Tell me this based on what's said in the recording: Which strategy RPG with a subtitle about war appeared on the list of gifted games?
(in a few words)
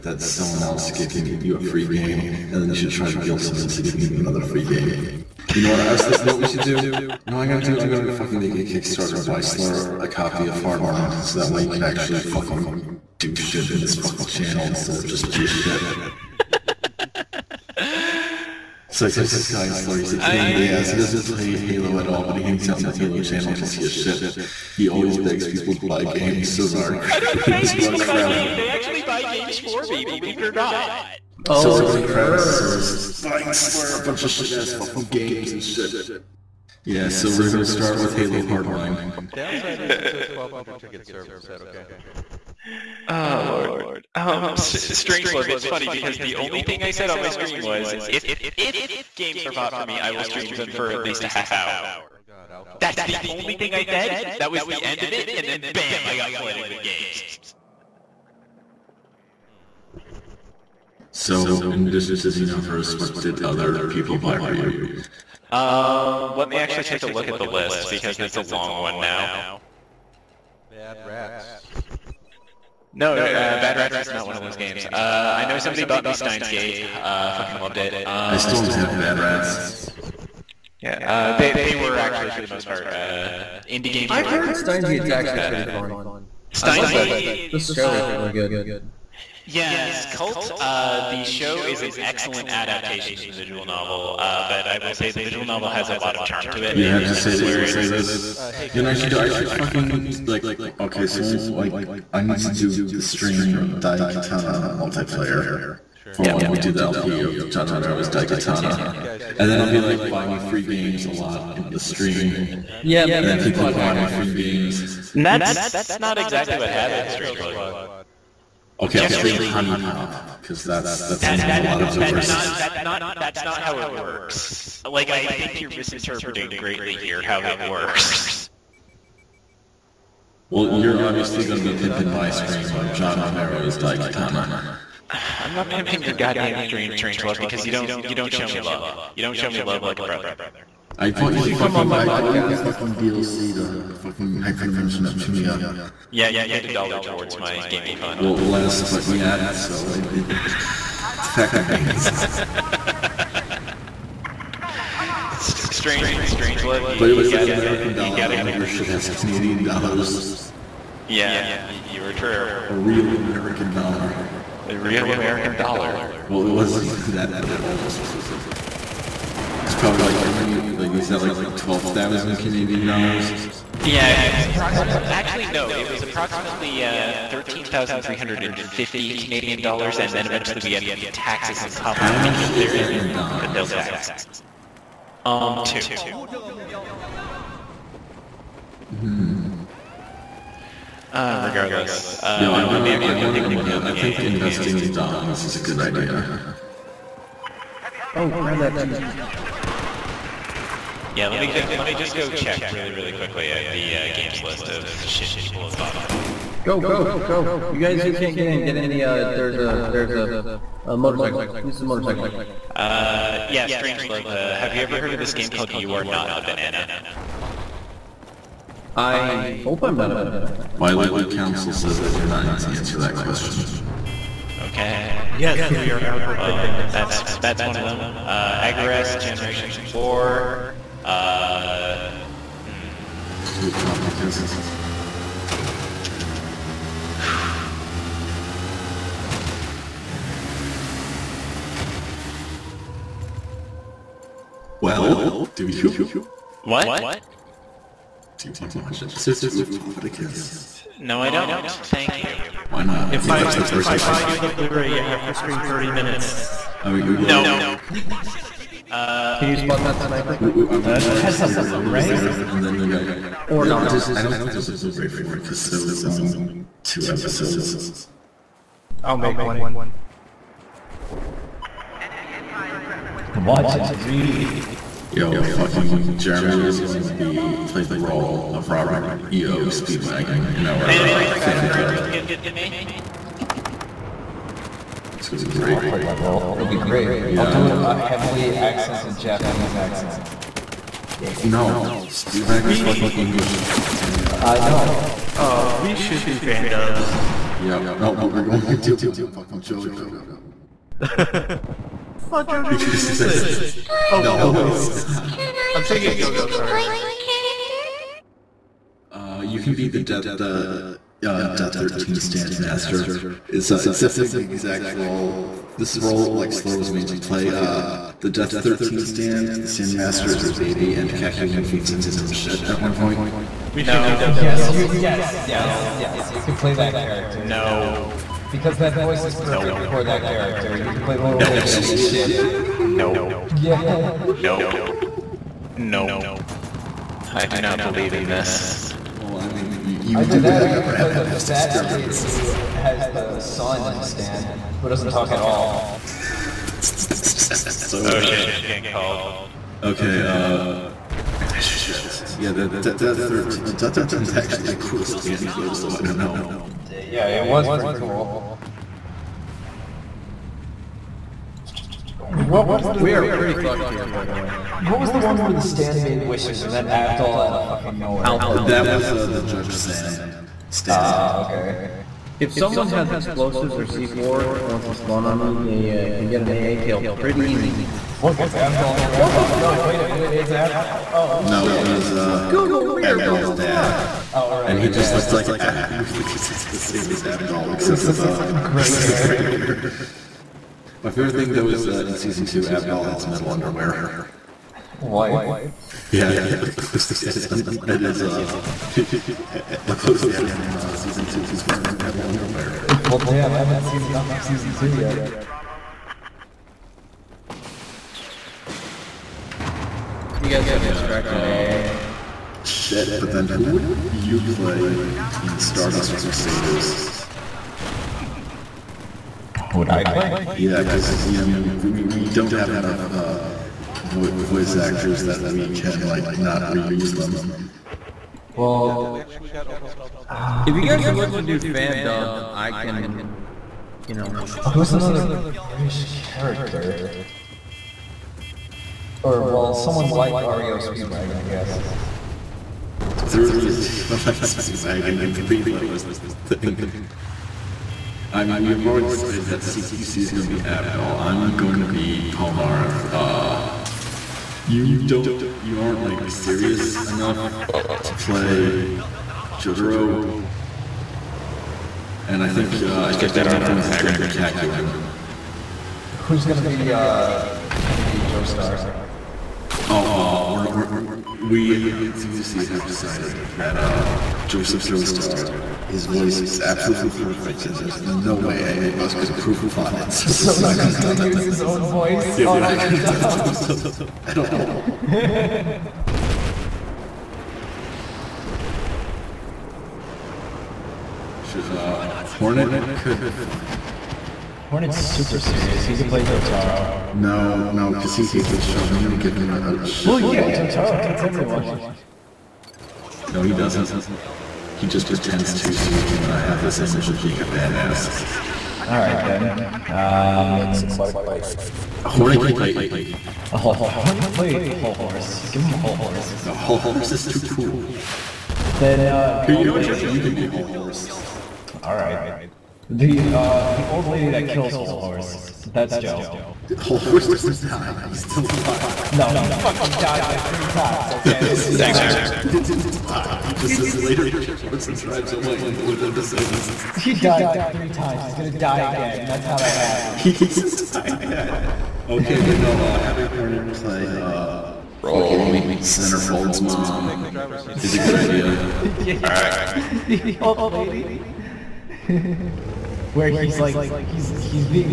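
Agarest, Generations of War.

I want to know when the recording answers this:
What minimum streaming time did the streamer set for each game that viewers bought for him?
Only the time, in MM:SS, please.
00:50.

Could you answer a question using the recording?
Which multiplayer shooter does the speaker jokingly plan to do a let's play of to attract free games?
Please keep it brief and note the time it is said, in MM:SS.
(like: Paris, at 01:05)
John Romero's Daikatana, at 01:47.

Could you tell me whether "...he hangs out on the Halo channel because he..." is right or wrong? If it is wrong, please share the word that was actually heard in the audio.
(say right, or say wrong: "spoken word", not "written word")
right.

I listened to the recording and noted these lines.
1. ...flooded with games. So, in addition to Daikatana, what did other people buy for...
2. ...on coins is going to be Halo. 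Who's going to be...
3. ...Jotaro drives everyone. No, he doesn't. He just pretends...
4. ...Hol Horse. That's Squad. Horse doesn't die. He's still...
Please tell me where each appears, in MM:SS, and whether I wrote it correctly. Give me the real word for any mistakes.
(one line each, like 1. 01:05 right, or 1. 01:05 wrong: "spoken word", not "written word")
1. 00:56 wrong: "Xenoverse", not "Daikatana"
2. 07:43 wrong: "Kakyoin", not "Halo"
3. 08:20 wrong: "hates", not "drives"
4. 08:44 wrong: "Joe", not "Squad".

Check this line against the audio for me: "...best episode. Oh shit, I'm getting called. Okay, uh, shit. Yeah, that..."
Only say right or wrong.
right.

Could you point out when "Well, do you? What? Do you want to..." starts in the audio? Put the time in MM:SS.
04:04.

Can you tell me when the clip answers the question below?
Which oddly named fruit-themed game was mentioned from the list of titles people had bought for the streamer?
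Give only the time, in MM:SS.
03:35.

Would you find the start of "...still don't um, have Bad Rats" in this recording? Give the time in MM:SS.
01:18.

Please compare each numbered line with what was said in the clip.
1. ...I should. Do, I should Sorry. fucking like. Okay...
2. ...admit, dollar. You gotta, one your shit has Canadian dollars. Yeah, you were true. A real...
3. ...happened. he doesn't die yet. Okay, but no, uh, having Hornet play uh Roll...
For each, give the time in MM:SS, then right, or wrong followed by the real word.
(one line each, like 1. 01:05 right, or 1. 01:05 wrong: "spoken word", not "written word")
1. 01:38 right
2. 02:37 right
3. 09:00 right.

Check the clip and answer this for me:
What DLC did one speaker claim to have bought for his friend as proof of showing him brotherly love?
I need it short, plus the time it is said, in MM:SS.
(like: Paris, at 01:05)
Hyperdimension Neptunia, at 02:24.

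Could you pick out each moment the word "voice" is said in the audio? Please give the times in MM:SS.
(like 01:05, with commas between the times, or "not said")
05:28, 07:04, 07:56, 08:01.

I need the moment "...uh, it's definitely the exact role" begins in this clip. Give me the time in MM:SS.
05:13.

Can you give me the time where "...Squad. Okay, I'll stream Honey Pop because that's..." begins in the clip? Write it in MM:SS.
01:57.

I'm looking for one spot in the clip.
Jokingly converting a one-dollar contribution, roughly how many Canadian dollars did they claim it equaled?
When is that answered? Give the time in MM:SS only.
02:57.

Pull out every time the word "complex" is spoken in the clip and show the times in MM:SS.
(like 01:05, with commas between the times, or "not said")
not said.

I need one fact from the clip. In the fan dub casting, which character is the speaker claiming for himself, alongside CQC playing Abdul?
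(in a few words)
Polnareff.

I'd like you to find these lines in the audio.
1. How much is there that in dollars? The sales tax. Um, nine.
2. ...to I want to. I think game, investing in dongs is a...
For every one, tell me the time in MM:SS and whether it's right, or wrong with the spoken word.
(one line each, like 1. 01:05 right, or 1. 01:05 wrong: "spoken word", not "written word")
1. 03:02 wrong: "two", not "nine"
2. 03:12 right.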